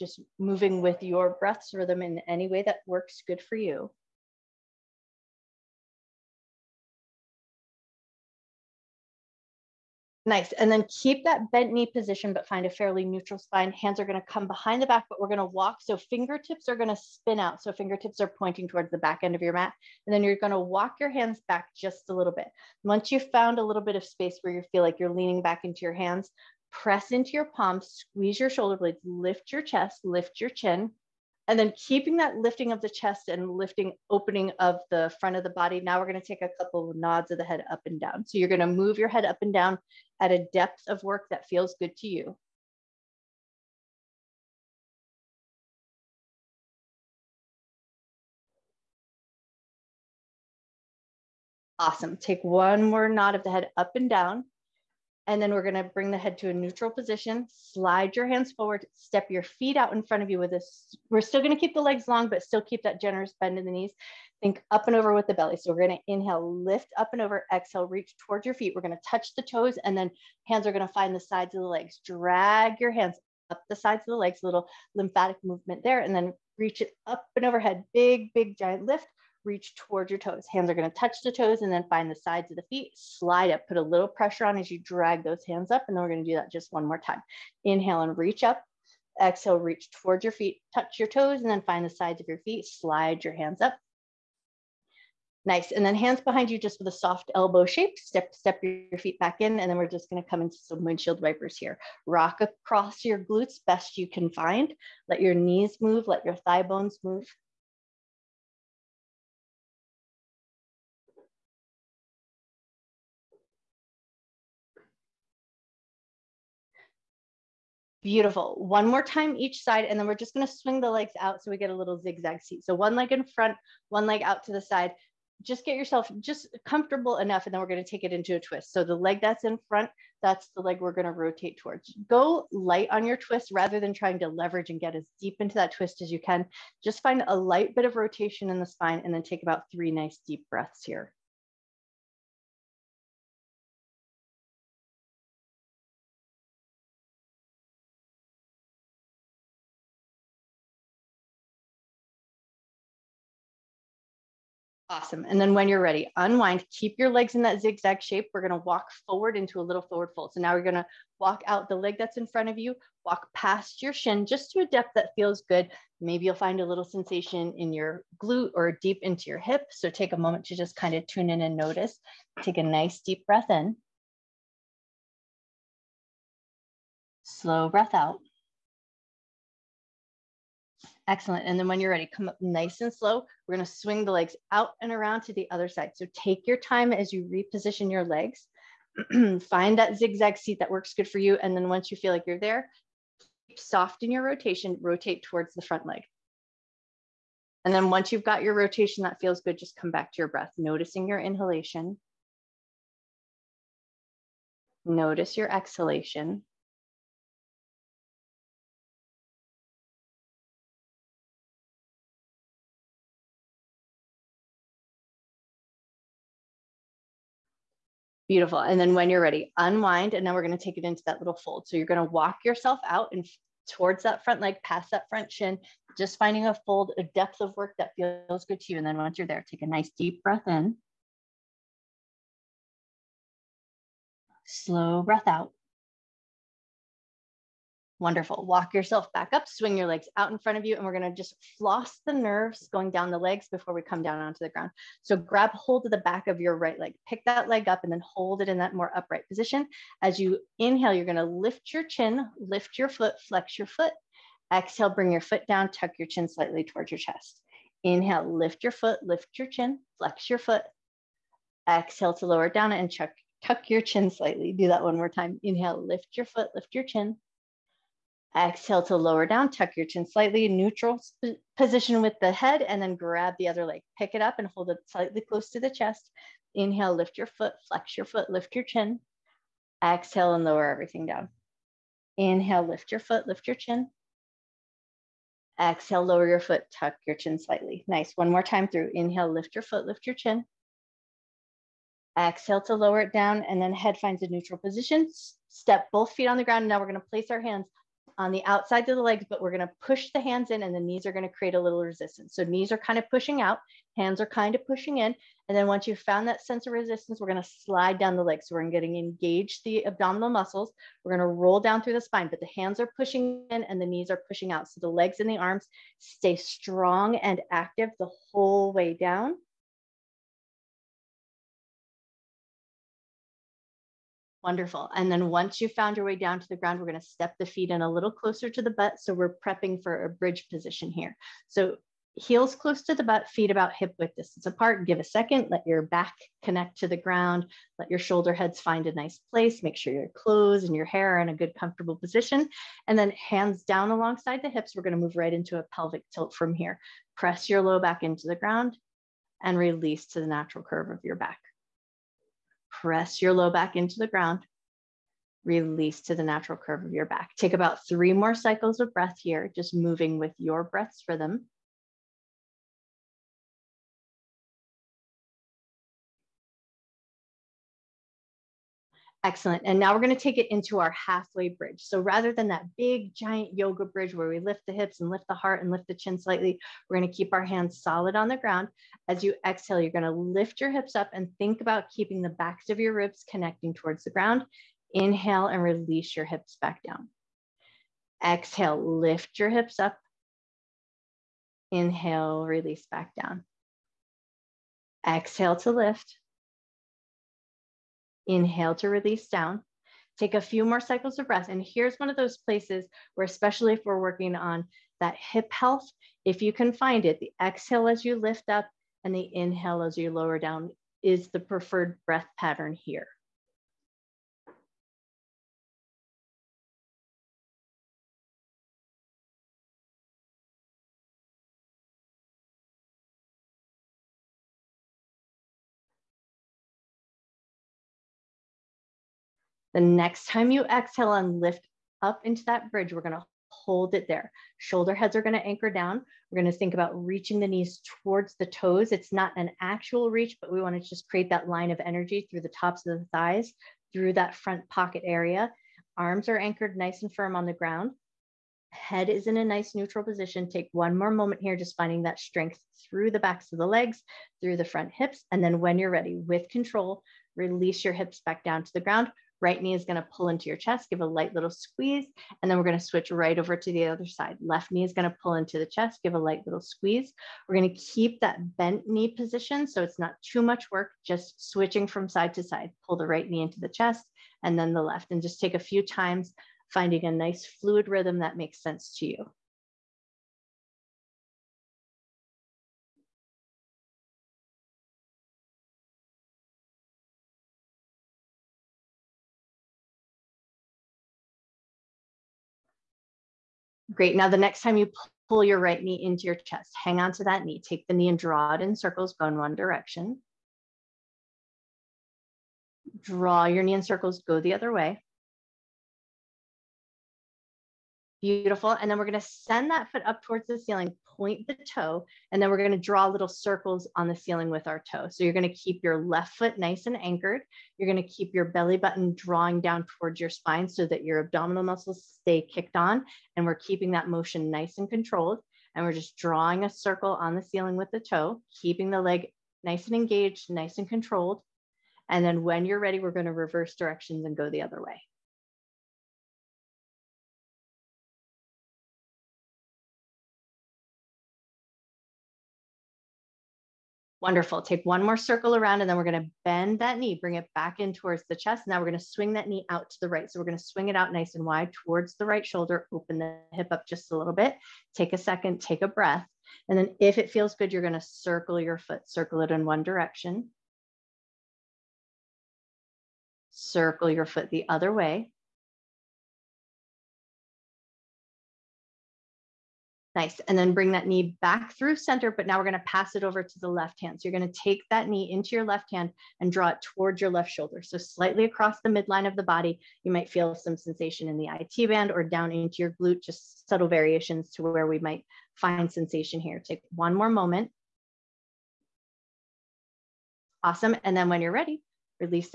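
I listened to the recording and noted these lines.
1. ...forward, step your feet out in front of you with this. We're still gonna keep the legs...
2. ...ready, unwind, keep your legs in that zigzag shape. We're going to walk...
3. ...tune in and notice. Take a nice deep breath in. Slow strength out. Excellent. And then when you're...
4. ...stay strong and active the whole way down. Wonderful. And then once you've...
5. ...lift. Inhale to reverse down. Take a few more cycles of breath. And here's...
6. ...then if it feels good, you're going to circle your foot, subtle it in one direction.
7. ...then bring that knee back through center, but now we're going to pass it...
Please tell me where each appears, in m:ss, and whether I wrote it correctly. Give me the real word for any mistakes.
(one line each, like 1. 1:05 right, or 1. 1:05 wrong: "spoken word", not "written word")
1. 0:58 right
2. 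2:35 right
3. 2:51 wrong: "breath", not "strength"
4. 5:15 right
5. 6:35 wrong: "release", not "reverse"
6. 9:16 wrong: "circle", not "subtle"
7. 9:30 right.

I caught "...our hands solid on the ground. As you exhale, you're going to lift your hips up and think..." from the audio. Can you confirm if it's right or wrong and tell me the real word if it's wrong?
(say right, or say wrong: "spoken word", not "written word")
right.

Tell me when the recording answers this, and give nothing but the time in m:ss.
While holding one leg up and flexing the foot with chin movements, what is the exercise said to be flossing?
4:02.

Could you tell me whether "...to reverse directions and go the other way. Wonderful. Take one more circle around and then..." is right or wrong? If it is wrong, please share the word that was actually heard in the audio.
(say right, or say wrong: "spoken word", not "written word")
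right.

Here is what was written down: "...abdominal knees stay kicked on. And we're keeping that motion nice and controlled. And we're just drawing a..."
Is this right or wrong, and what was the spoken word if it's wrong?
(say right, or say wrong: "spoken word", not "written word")
wrong: "muscles", not "knees".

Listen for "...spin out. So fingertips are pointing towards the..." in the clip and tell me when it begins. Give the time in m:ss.
0:16.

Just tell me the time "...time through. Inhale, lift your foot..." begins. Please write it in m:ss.
4:48.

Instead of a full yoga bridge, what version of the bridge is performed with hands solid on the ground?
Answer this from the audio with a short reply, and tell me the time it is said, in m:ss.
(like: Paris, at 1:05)
Halfway bridge, at 6:10.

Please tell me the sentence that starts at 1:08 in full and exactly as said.
We're gonna touch the toes and then hands are gonna find the sides of the legs.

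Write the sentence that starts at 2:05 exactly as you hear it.
Just get yourself just comfortable enough, and then we're going to take it into a twist.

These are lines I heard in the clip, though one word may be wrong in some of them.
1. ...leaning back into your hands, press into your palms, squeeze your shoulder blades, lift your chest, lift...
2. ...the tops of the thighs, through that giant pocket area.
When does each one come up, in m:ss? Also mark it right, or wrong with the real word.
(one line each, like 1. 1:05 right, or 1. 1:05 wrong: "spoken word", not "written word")
1. 0:25 right
2. 7:22 wrong: "front", not "giant".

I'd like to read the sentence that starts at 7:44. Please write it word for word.
Left knee is going to pull into the chest, give a light little squeeze.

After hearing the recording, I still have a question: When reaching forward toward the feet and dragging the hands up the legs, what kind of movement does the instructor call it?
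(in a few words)
Lymphatic movement.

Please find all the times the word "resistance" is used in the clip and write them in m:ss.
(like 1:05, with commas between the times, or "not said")
5:01, 5:06.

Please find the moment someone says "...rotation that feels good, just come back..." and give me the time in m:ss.
3:18.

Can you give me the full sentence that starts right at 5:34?
Give a second, let your back connect to the ground, let your shoulder heads find a nice place.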